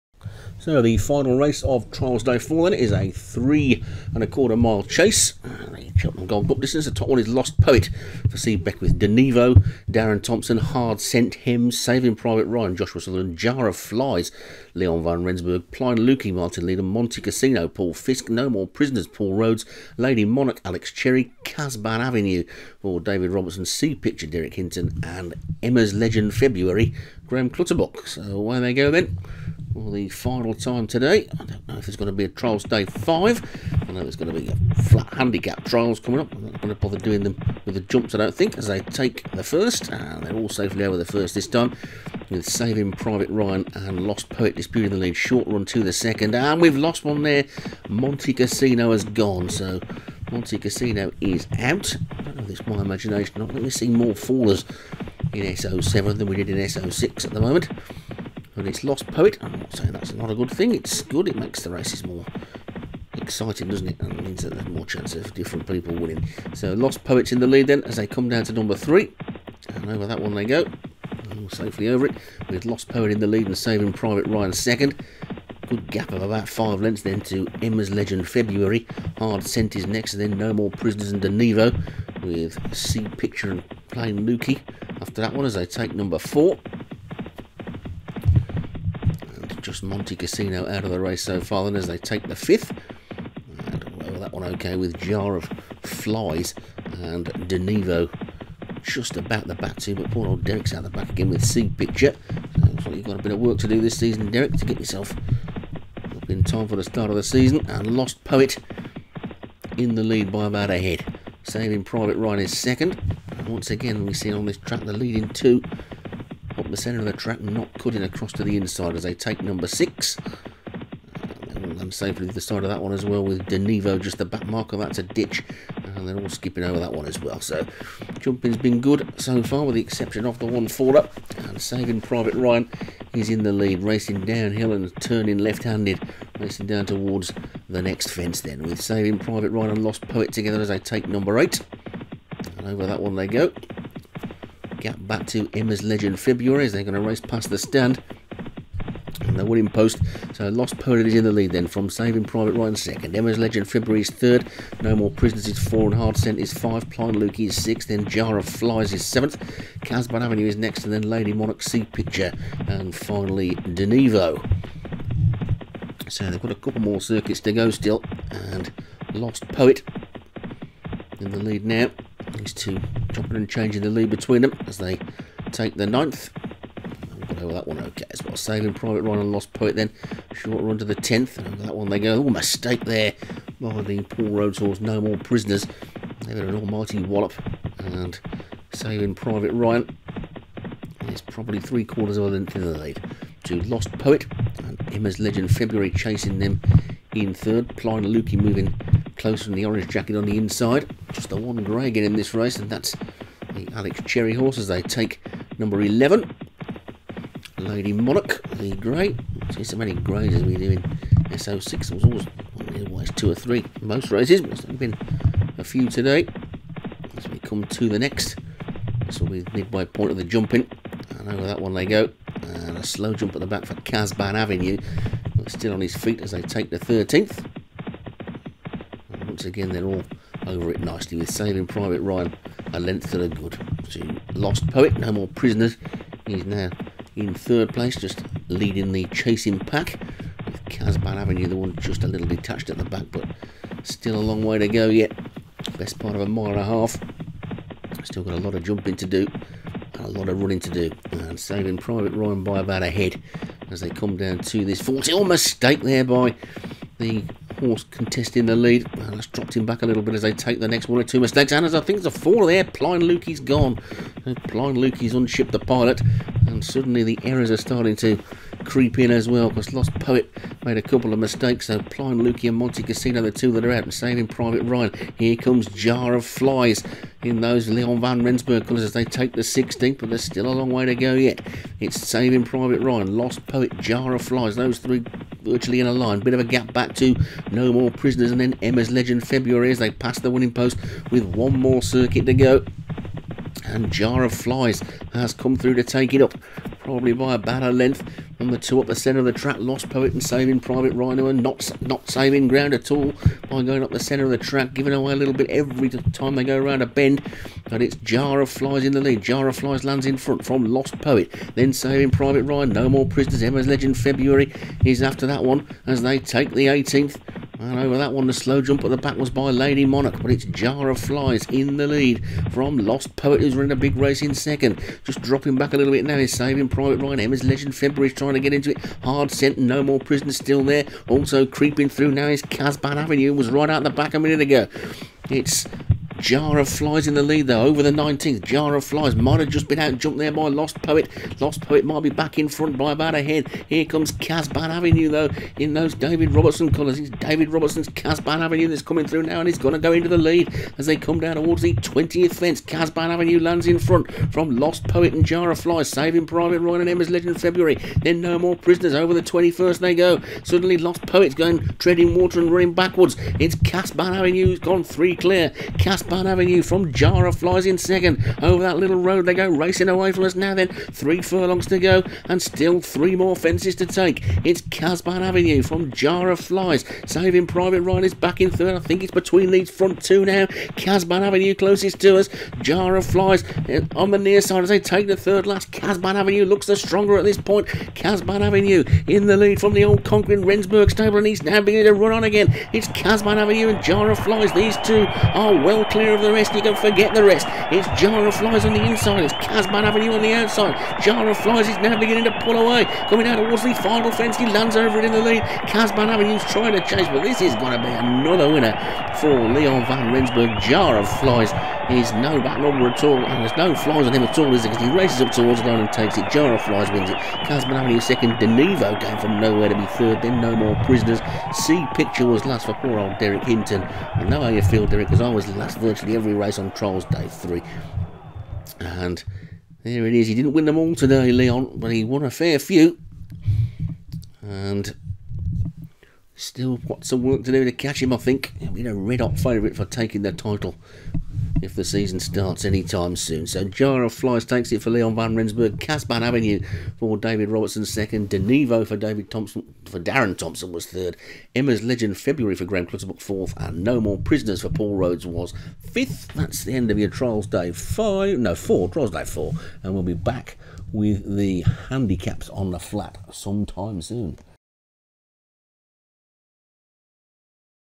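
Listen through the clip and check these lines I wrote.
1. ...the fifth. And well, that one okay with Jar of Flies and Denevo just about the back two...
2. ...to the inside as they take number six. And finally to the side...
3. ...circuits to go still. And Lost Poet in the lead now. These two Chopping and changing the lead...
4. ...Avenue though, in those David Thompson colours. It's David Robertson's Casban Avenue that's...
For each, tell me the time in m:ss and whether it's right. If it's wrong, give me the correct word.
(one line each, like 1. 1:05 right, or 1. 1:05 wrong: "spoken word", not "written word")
1. 1:32 right
2. 1:58 wrong: "safely", not "finally"
3. 2:47 right
4. 5:44 wrong: "Robertson", not "Thompson".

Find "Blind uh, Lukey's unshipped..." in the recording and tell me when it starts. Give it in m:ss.
4:24.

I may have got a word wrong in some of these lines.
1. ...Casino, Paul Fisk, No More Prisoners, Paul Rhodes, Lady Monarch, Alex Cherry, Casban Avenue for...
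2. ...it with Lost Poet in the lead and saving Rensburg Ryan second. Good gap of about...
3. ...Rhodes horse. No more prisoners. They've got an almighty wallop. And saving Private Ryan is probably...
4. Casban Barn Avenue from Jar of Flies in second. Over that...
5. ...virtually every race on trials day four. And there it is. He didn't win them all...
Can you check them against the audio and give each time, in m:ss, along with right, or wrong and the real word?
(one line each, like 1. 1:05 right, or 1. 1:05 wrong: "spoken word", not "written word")
1. 0:17 right
2. 1:12 wrong: "Private", not "Rensburg"
3. 3:04 right
4. 6:05 right
5. 7:05 wrong: "three", not "four".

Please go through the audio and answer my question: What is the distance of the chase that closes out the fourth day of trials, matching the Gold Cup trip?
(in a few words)
3.25 miles.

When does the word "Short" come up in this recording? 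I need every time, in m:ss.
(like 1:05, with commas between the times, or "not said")
0:45, 3:00.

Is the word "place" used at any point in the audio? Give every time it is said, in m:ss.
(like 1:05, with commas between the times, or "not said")
3:57.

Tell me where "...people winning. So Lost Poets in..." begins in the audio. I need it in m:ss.
1:05.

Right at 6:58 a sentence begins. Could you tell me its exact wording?
Denevo going from nowhere to be third.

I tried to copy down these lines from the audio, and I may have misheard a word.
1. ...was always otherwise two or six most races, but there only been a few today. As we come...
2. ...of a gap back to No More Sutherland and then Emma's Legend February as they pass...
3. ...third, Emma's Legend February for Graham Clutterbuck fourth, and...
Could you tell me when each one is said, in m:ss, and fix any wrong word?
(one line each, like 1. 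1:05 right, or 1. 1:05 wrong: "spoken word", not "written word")
1. 3:31 wrong: "three", not "six"
2. 4:46 wrong: "Prisoners", not "Sutherland"
3. 7:30 right.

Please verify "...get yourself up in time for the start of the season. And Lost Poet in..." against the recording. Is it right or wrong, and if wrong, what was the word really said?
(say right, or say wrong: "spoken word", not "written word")
right.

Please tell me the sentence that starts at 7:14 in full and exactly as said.
And still got some work to do to catch him, I think.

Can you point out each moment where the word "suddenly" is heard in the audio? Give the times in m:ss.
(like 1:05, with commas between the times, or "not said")
4:26, 6:00.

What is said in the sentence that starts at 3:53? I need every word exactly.
So Lost Poet, no more prisoners.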